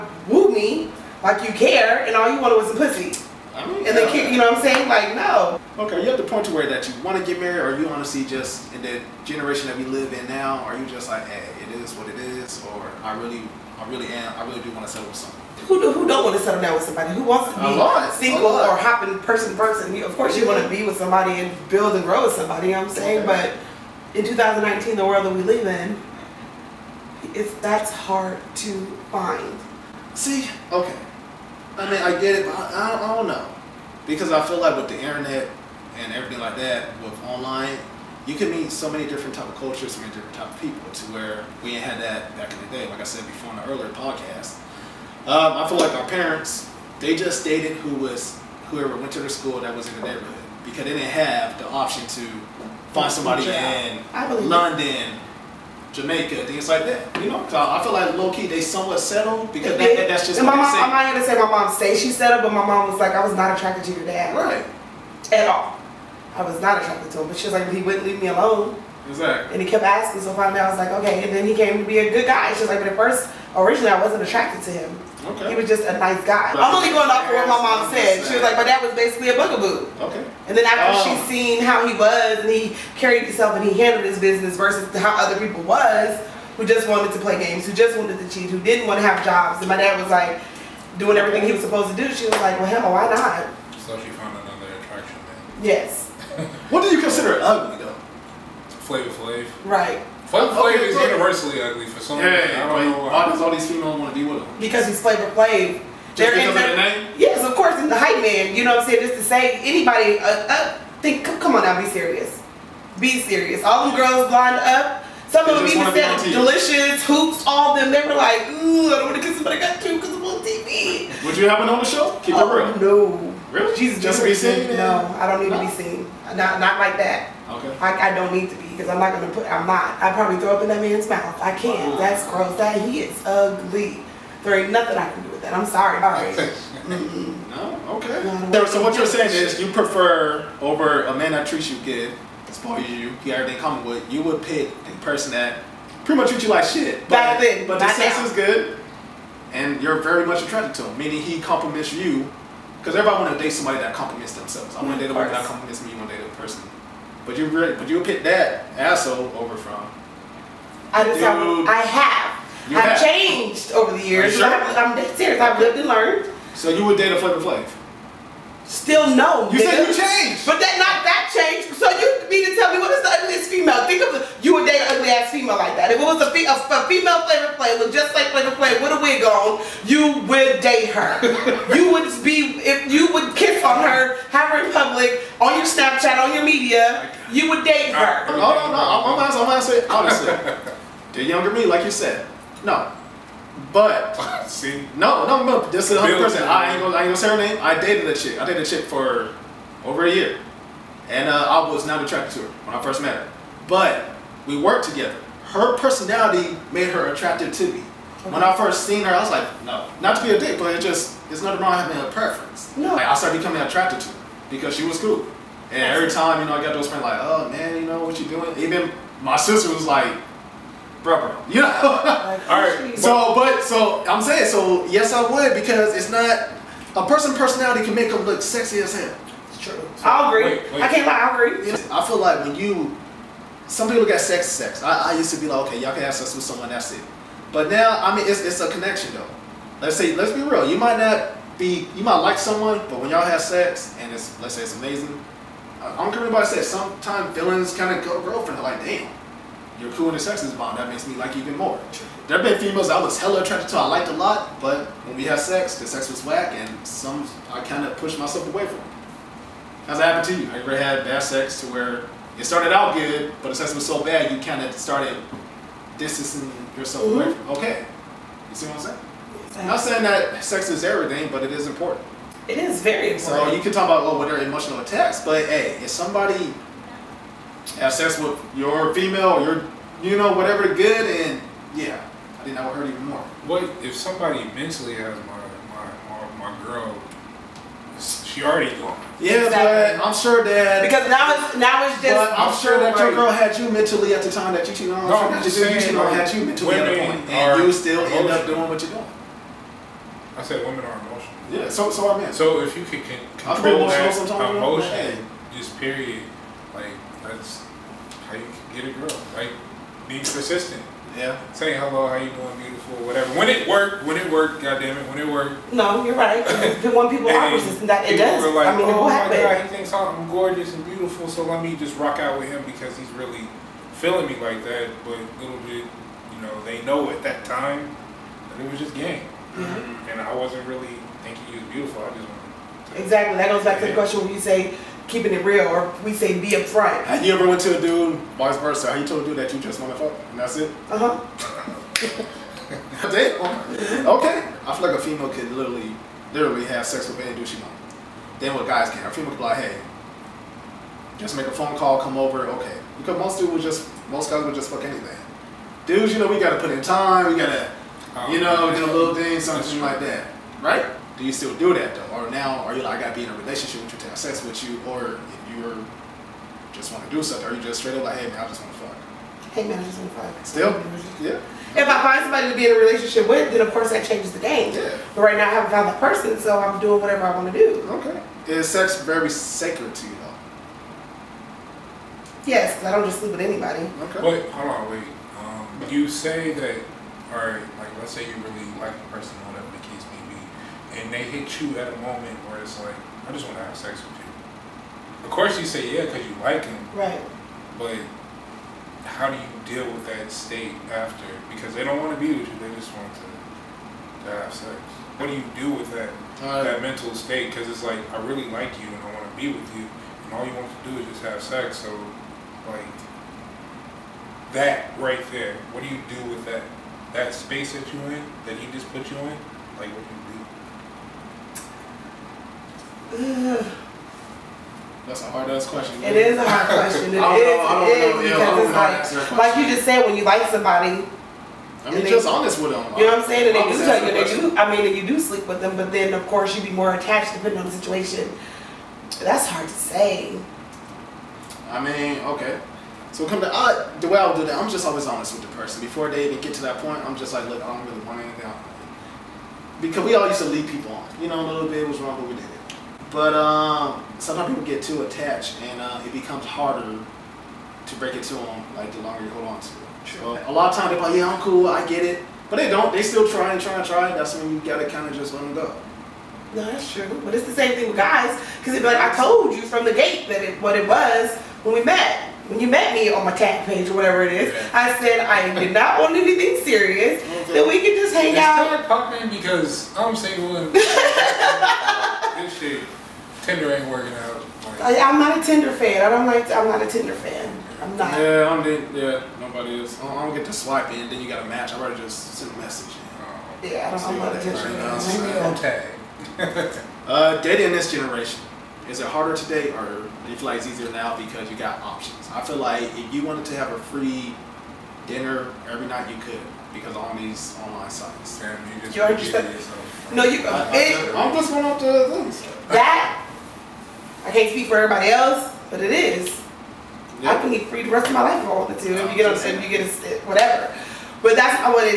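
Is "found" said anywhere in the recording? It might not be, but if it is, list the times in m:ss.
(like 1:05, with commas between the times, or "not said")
1:34, 6:15.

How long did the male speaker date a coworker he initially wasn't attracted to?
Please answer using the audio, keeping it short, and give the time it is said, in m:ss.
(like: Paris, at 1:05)
over a year, at 3:19.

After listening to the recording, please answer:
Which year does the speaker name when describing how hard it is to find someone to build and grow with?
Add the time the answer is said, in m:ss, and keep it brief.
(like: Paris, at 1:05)
2019, at 0:24.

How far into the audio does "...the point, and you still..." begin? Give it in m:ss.
4:56.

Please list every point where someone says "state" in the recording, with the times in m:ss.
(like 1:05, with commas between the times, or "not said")
6:40, 6:47.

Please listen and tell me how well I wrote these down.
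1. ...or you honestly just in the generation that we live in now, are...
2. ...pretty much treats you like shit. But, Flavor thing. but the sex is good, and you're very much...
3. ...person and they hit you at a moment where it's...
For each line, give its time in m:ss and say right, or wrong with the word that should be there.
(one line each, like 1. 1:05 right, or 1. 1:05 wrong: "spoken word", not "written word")
1. 0:07 right
2. 2:26 wrong: "Back", not "Flavor"
3. 6:29 right.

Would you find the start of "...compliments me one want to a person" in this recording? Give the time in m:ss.
2:35.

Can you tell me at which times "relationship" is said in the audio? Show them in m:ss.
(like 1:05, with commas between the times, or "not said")
6:03, 6:12.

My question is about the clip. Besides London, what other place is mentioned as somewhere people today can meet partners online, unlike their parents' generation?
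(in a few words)
Jamaica.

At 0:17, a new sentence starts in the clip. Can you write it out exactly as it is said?
Who wants to be lot, single or hopping person person?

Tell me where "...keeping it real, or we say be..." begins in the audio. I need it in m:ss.
5:35.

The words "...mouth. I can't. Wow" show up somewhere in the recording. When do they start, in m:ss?
2:11.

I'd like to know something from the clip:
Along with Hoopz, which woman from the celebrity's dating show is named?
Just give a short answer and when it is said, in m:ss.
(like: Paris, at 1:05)
Deelishis, at 1:56.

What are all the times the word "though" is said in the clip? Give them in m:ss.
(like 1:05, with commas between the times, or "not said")
1:37, 3:59, 6:01, 6:20.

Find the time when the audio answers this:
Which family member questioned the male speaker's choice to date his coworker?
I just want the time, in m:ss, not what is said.
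3:39.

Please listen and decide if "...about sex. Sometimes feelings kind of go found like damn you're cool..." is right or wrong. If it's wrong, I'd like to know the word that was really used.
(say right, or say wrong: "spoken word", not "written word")
wrong: "girlfriend", not "found".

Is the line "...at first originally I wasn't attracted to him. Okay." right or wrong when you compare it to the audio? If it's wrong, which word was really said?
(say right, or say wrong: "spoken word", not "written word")
right.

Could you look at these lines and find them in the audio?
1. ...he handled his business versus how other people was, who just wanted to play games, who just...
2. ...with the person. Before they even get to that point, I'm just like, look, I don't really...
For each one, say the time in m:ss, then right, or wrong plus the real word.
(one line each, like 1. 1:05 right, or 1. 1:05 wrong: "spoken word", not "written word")
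1. 1:23 right
2. 7:25 right.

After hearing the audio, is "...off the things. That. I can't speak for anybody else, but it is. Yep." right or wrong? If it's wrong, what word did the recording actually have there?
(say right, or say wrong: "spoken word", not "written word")
wrong: "everybody", not "anybody".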